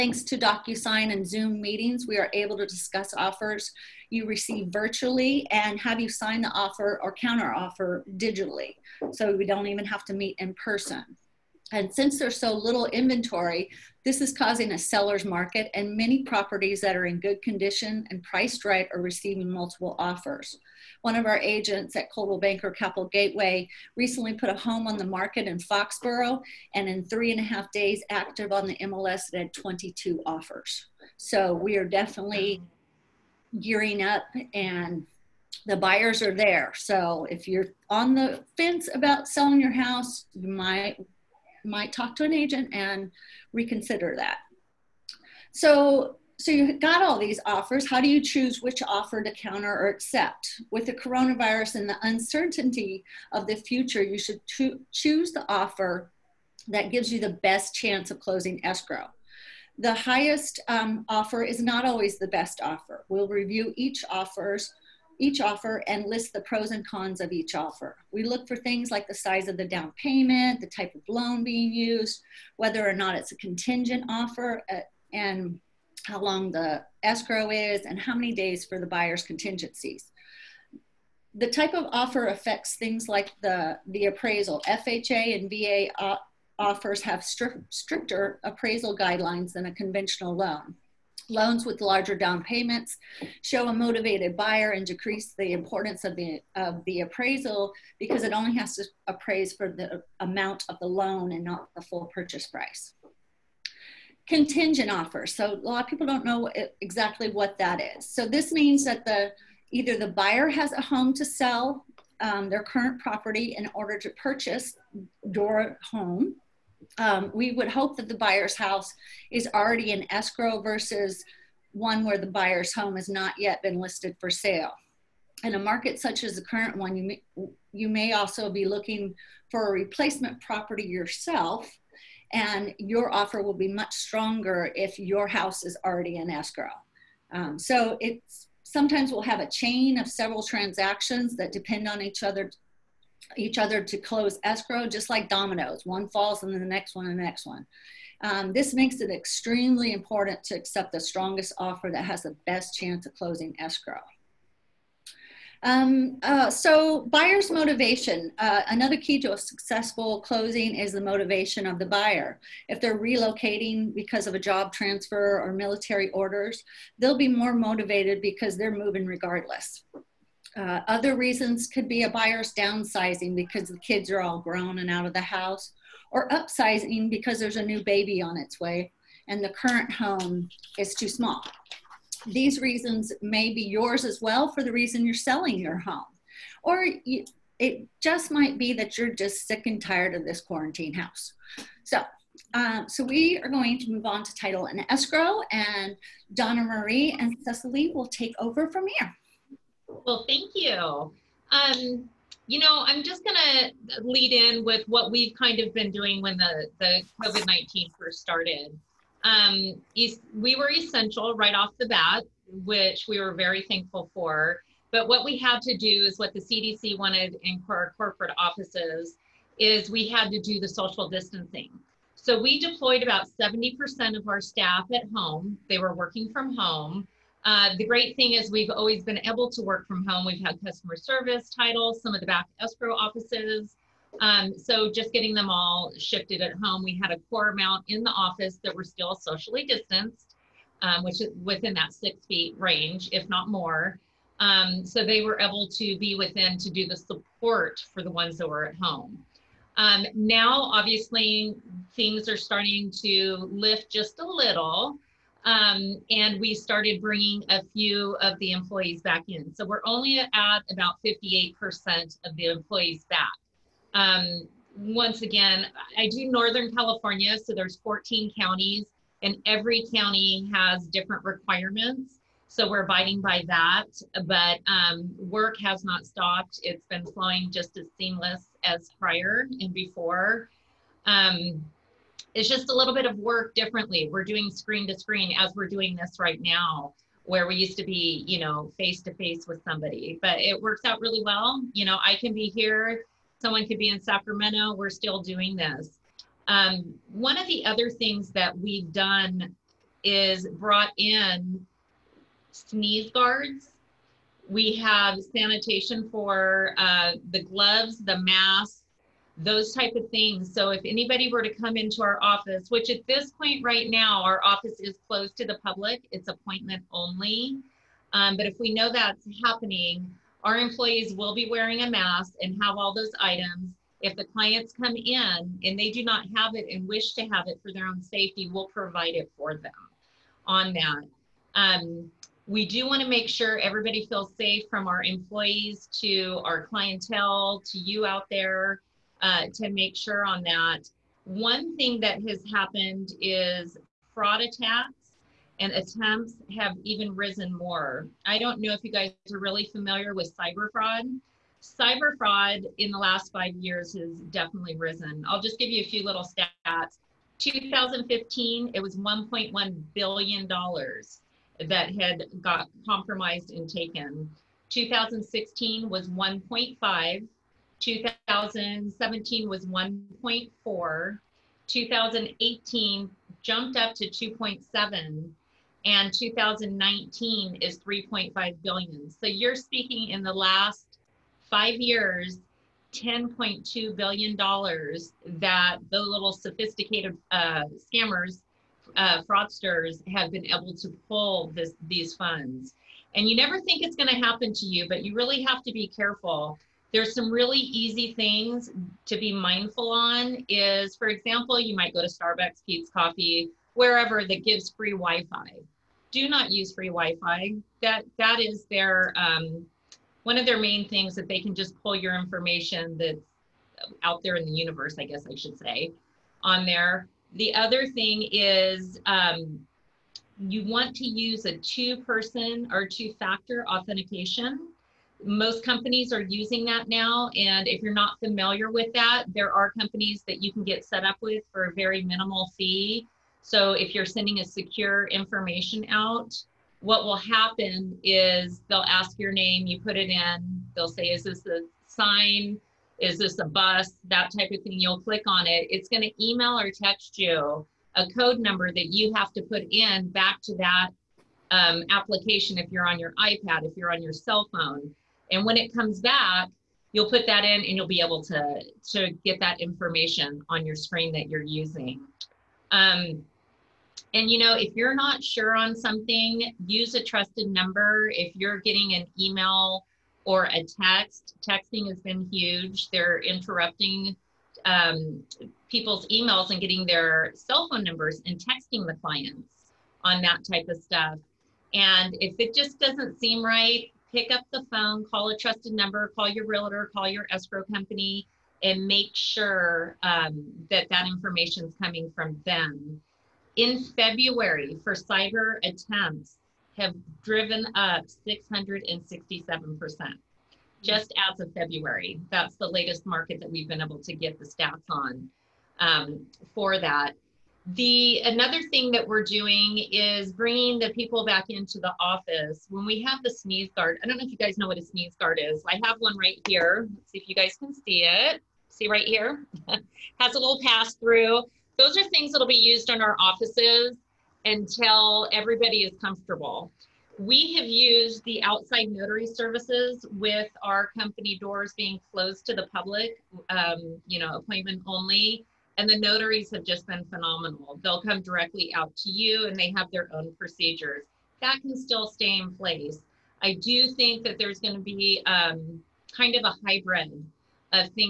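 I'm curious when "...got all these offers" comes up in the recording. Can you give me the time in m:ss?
0:46.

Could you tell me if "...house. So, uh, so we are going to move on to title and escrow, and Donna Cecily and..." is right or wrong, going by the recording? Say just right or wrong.
wrong.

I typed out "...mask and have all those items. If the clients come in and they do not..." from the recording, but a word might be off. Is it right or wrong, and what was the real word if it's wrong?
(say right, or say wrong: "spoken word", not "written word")
right.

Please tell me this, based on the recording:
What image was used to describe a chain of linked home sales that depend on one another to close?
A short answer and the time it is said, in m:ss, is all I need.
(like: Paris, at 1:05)
dominoes, at 2:25.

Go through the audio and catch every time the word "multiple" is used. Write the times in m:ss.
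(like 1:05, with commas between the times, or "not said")
0:19.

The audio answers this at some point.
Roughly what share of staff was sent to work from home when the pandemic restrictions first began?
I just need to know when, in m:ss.
3:43.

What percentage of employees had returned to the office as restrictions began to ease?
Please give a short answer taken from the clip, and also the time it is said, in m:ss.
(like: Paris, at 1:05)
58%, at 4:21.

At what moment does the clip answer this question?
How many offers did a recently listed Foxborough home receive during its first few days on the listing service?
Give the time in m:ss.
0:29.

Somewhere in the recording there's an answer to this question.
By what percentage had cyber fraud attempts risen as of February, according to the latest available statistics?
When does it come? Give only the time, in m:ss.
8:18.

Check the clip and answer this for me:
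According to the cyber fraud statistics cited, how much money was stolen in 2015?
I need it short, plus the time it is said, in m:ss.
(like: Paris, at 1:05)
$1.1 billion, at 5:58.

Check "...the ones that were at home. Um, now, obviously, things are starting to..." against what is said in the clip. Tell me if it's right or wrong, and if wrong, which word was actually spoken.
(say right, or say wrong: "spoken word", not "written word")
right.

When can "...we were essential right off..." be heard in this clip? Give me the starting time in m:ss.
3:29.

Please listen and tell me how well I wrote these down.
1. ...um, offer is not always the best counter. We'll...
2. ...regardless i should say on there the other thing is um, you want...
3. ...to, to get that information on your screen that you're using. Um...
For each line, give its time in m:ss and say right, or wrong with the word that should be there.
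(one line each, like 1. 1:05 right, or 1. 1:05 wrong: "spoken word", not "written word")
1. 1:00 wrong: "offer", not "counter"
2. 6:55 wrong: "guess", not "regardless"
3. 7:38 right.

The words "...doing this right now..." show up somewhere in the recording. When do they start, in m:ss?
4:45.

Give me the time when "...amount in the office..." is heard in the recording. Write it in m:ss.
3:57.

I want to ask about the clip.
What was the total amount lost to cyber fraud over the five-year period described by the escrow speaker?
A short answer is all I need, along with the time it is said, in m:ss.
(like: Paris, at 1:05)
10.2 billion dollars, at 6:22.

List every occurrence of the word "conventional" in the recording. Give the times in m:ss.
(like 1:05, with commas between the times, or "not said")
1:29.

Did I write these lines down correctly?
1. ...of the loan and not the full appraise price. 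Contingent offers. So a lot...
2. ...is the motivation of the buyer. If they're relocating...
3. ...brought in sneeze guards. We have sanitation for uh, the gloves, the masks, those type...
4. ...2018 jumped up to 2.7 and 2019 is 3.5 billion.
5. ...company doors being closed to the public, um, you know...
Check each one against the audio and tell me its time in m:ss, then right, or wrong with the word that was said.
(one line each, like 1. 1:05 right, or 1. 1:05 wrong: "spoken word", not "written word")
1. 1:40 wrong: "purchase", not "appraise"
2. 2:40 right
3. 5:00 right
4. 6:11 right
5. 8:50 right.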